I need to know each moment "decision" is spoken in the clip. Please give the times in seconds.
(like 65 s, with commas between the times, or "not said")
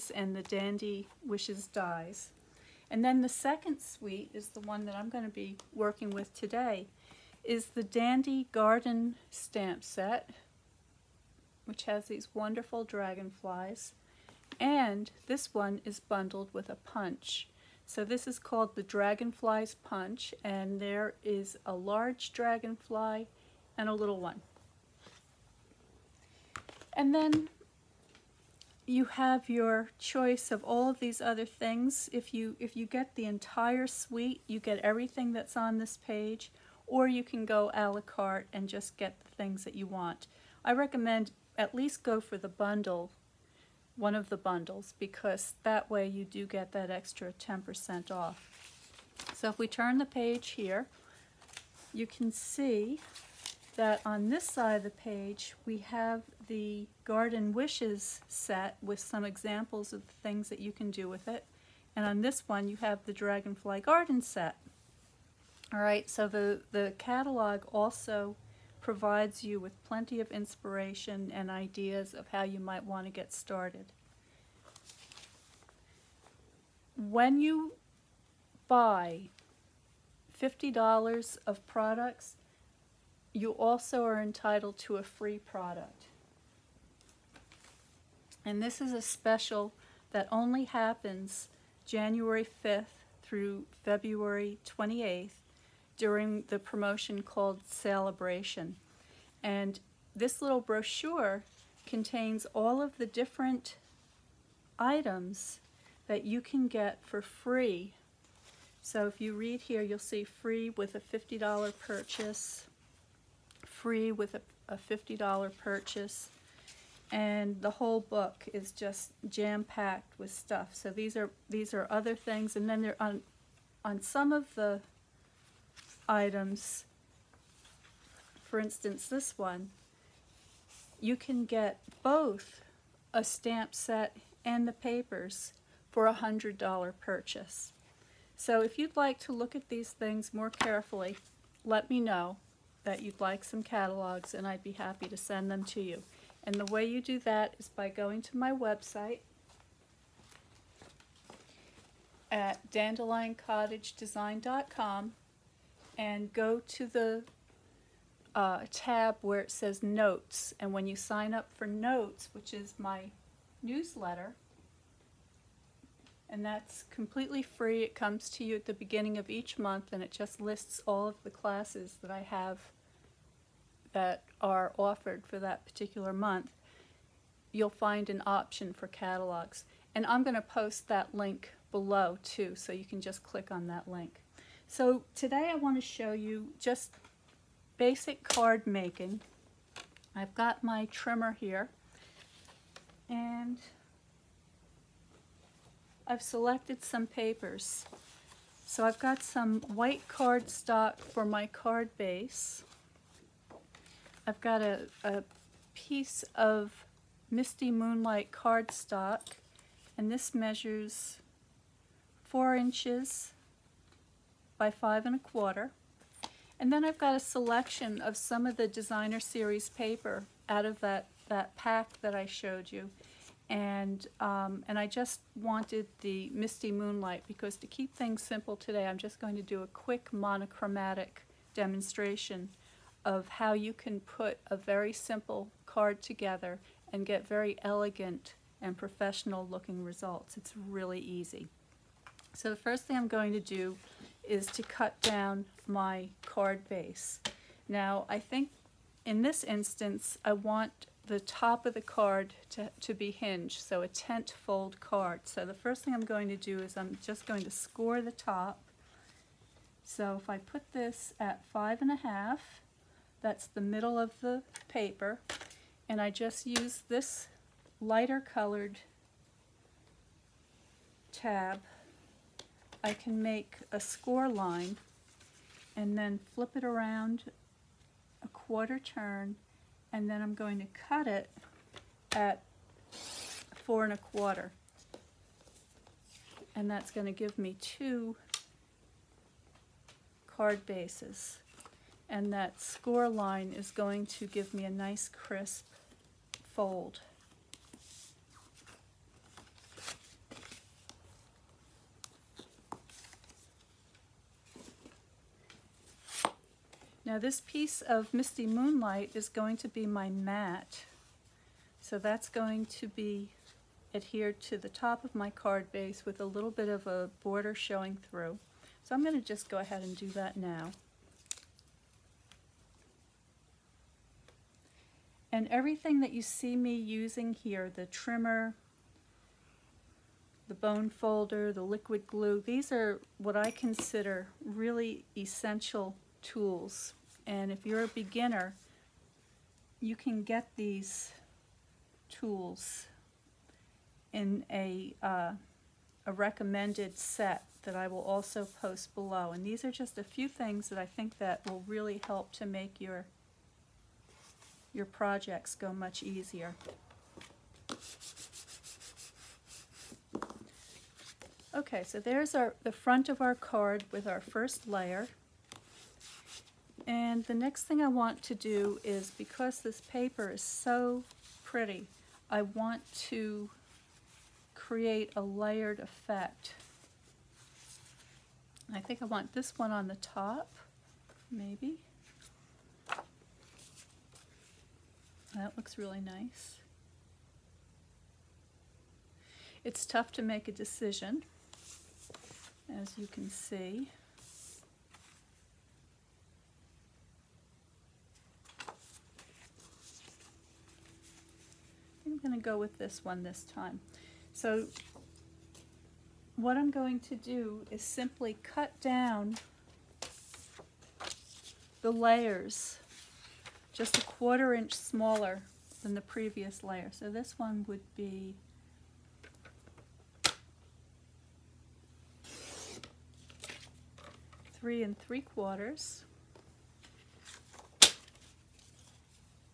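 390 s.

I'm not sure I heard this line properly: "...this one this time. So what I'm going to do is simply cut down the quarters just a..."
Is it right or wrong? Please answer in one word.
wrong.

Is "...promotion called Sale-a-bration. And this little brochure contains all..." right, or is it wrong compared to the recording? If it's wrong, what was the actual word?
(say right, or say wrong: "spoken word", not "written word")
right.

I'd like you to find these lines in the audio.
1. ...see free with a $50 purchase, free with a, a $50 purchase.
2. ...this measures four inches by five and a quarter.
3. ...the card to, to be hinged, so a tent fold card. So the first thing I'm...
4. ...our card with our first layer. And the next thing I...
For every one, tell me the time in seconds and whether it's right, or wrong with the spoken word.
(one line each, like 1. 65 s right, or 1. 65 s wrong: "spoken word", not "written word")
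1. 109 s right
2. 210 s right
3. 251 s right
4. 363 s right.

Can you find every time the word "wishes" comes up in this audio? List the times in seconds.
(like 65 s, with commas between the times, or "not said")
1 s, 57 s.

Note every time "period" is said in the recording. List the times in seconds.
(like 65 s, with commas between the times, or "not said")
not said.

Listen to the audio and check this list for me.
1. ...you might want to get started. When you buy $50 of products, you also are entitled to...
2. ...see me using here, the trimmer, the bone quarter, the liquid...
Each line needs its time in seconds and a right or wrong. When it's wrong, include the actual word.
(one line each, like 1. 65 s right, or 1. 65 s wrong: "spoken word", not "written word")
1. 72 s right
2. 326 s wrong: "folder", not "quarter".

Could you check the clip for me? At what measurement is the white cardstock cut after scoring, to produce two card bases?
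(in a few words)
4 1/4 inches.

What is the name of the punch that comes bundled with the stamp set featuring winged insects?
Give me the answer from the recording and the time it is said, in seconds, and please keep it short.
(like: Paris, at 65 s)
Dragonflies Punch, at 18 s.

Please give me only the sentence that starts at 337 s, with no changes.
And if you're a beginner, you can get these tools in a, uh, a recommended set that I will also post below.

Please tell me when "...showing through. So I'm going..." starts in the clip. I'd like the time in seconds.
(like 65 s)
317 s.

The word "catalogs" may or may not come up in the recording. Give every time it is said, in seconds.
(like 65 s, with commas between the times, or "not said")
66 s, 143 s, 178 s.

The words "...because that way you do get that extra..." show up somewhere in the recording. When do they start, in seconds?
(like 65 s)
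44 s.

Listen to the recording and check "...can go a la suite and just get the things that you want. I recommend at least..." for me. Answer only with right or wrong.
wrong.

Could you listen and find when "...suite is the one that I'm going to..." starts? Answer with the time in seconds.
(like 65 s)
3 s.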